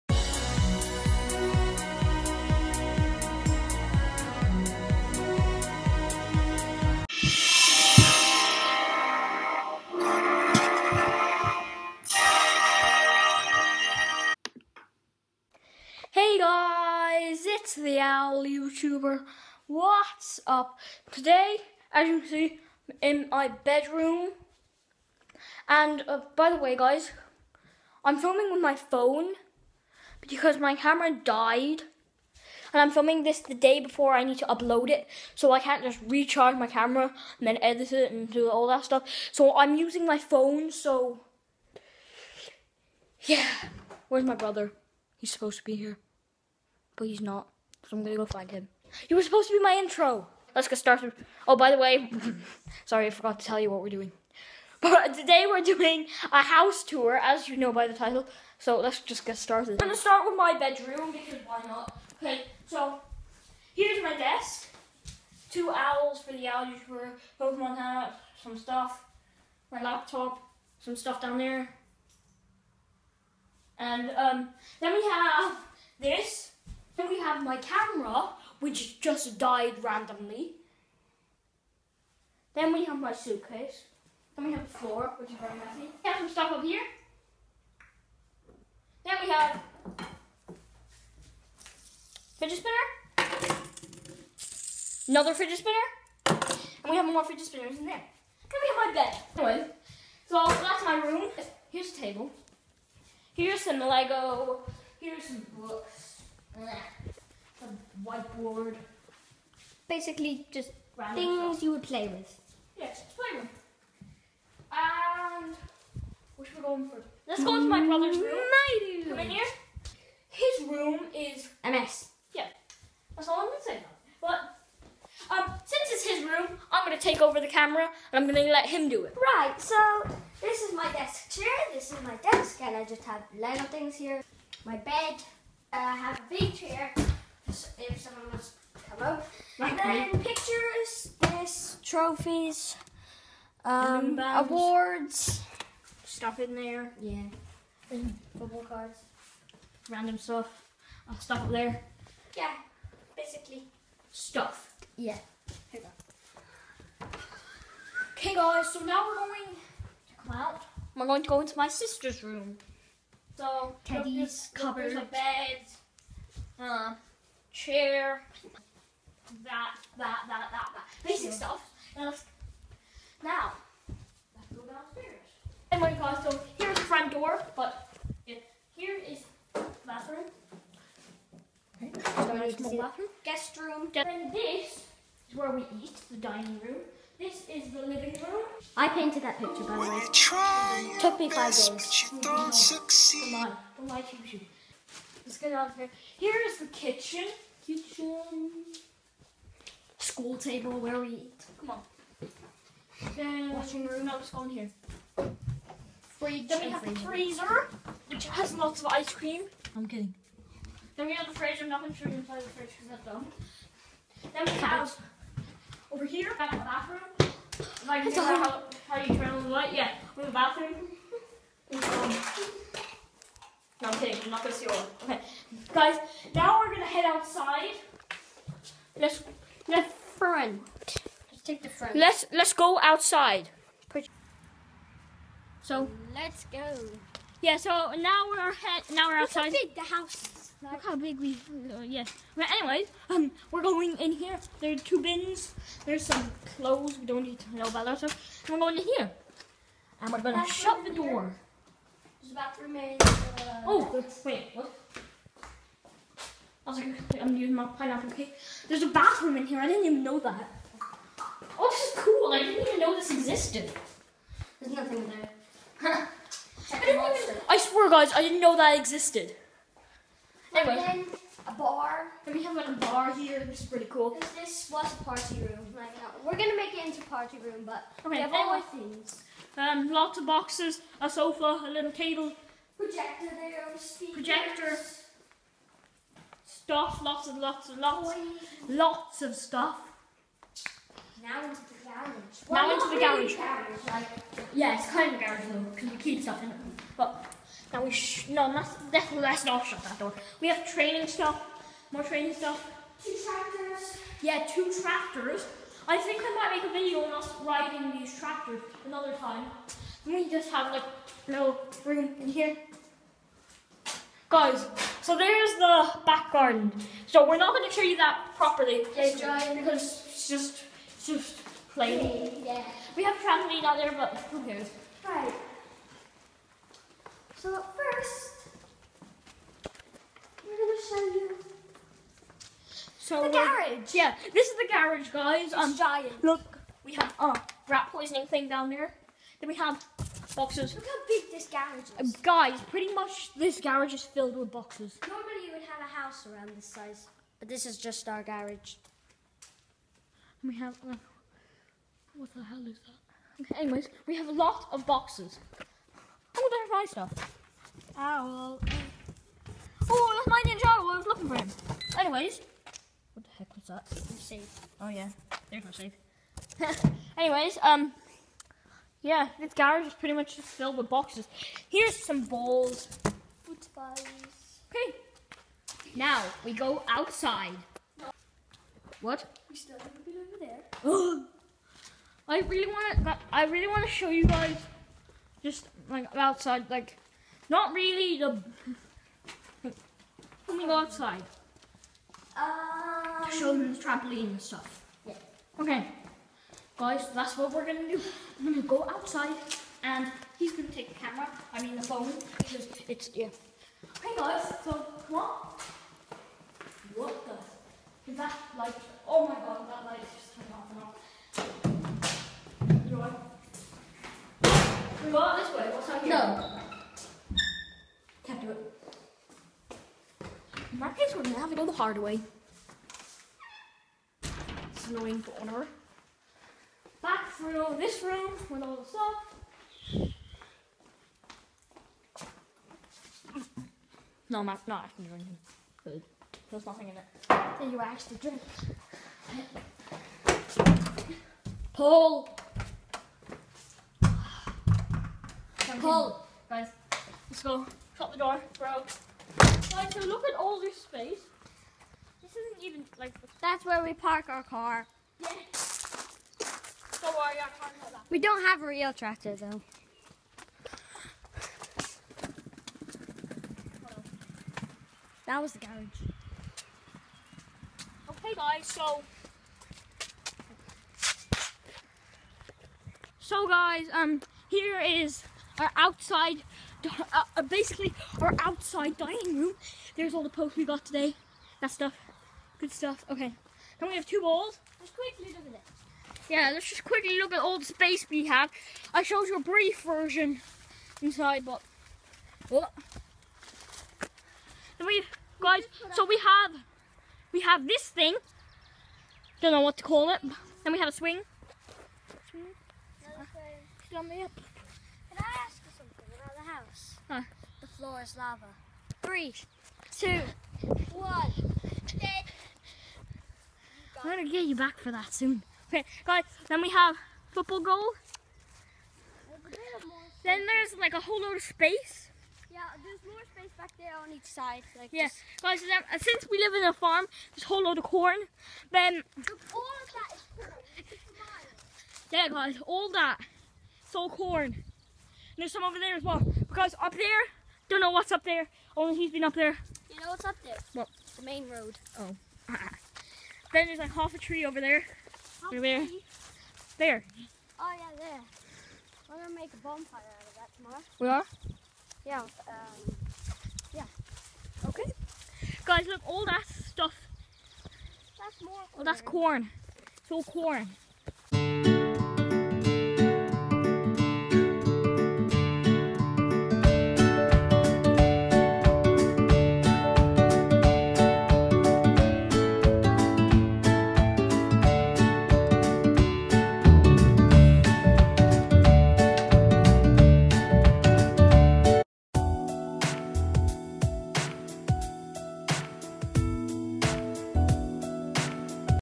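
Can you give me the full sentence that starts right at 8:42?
Yeah, there's more space back there on each side.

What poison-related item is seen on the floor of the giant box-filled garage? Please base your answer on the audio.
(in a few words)
Rat poisoning thing.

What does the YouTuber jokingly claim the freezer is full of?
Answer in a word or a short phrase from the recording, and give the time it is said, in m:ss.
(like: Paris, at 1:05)
Ice cream, at 3:28.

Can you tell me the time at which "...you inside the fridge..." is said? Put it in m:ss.
3:32.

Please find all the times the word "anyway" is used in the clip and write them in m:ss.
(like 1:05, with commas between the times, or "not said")
1:39, 4:02, 4:30, 5:53, 6:01, 6:07.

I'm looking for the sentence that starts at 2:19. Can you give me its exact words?
and then pictures, this, trophies, um, awards, stuff in there.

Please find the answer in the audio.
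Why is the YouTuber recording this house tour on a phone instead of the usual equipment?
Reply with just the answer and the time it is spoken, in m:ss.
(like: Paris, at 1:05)
Camera died, at 0:30.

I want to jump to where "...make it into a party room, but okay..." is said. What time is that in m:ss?
4:36.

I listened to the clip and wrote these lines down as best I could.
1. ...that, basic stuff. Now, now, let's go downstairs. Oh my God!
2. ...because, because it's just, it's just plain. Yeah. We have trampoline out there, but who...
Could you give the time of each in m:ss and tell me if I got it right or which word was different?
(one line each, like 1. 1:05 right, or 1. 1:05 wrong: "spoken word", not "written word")
1. 2:50 right
2. 5:18 right.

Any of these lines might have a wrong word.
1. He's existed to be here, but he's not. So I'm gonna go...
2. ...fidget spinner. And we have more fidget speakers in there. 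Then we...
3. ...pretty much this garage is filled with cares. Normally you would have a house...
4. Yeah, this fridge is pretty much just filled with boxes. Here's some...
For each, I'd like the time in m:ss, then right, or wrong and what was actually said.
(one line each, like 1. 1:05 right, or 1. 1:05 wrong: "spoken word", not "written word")
1. 0:45 wrong: "supposed", not "existed"
2. 1:35 wrong: "spinners", not "speakers"
3. 5:42 wrong: "boxes", not "cares"
4. 6:09 wrong: "garage", not "fridge".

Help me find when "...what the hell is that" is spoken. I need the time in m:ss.
5:52.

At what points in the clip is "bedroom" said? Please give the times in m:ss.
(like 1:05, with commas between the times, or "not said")
0:23, 1:00.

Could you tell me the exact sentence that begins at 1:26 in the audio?
We have some stuff up here.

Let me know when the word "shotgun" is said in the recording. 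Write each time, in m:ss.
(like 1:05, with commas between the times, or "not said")
not said.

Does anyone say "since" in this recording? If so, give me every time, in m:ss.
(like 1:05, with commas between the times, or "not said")
2:05, 8:45.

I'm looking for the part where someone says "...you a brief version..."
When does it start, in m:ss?
8:09.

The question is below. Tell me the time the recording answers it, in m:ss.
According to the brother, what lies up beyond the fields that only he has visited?
9:01.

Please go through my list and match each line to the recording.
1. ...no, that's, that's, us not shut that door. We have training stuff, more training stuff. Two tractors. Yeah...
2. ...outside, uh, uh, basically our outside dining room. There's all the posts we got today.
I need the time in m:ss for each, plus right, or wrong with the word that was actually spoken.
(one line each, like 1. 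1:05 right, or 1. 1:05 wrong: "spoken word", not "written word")
1. 4:58 right
2. 7:55 right.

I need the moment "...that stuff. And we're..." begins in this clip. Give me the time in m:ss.
4:07.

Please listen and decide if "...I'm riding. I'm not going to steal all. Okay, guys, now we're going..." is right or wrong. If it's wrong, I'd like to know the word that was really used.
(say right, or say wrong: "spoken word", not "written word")
wrong: "kidding", not "riding".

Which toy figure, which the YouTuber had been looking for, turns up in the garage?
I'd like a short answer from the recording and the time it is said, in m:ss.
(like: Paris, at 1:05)
Ninjago, at 6:00.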